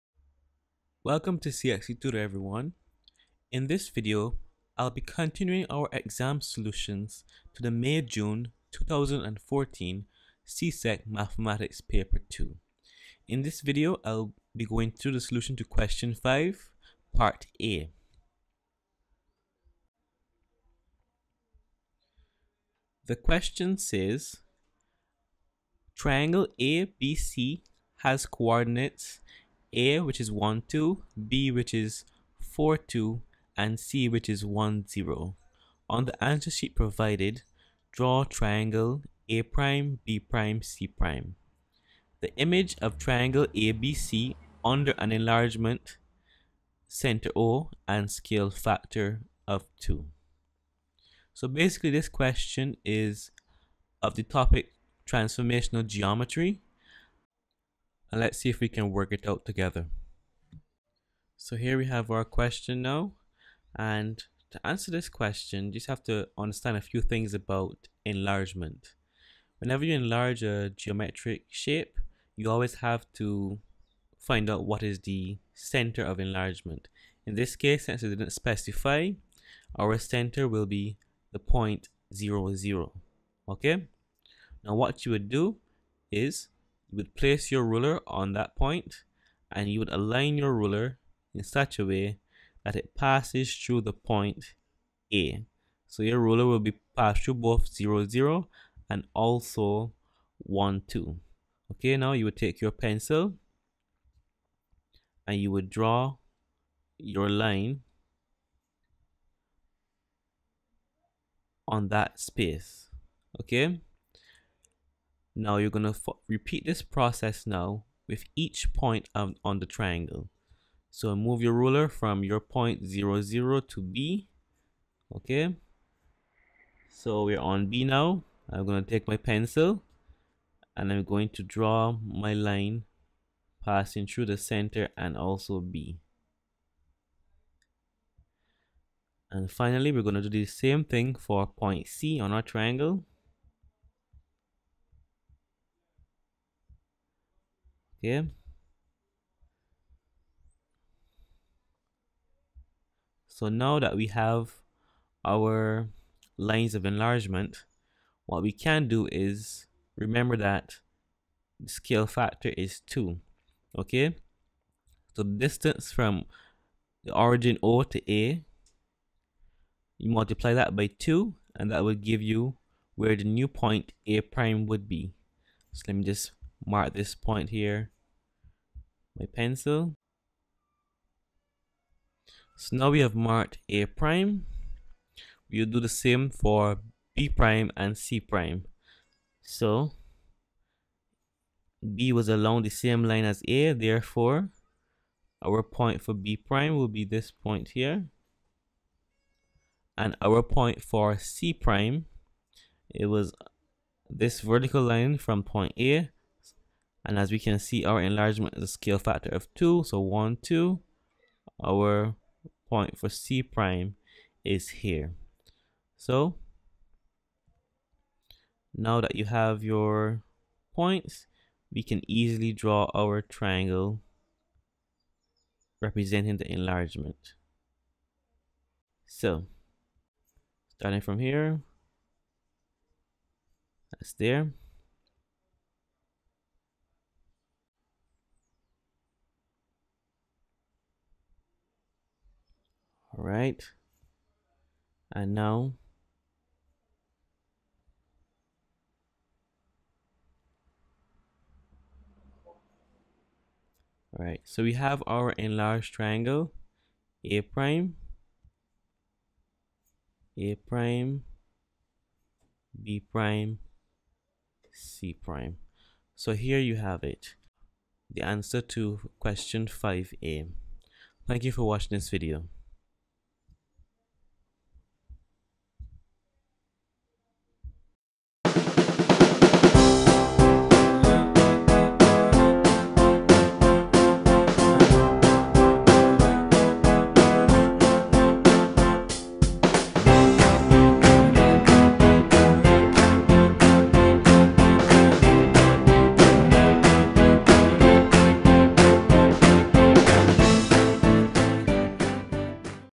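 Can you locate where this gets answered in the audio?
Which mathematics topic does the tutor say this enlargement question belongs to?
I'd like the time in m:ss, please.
0:55.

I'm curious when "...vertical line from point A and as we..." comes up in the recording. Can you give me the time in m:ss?
3:24.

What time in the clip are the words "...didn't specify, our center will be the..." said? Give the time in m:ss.
1:18.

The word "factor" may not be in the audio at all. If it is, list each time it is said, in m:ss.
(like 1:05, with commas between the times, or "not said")
0:48, 2:42, 3:28.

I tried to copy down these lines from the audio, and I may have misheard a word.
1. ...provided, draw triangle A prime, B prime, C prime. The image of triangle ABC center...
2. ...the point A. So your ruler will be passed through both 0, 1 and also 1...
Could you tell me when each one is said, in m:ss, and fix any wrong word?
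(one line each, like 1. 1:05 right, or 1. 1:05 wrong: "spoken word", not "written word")
1. 0:36 wrong: "under", not "center"
2. 1:33 wrong: "0", not "1".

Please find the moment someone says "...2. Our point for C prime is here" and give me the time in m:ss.
3:30.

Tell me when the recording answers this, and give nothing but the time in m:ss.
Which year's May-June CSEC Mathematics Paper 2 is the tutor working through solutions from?
0:07.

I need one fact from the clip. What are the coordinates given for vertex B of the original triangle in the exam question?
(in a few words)
(4, 2).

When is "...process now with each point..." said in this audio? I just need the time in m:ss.
1:56.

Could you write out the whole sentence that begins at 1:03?
And to answer this question, you just have to understand a few things about enlargement.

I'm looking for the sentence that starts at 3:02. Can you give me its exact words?
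So now we have marked A prime.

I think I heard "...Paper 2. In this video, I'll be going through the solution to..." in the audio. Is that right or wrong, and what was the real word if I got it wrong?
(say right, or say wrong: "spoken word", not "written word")
right.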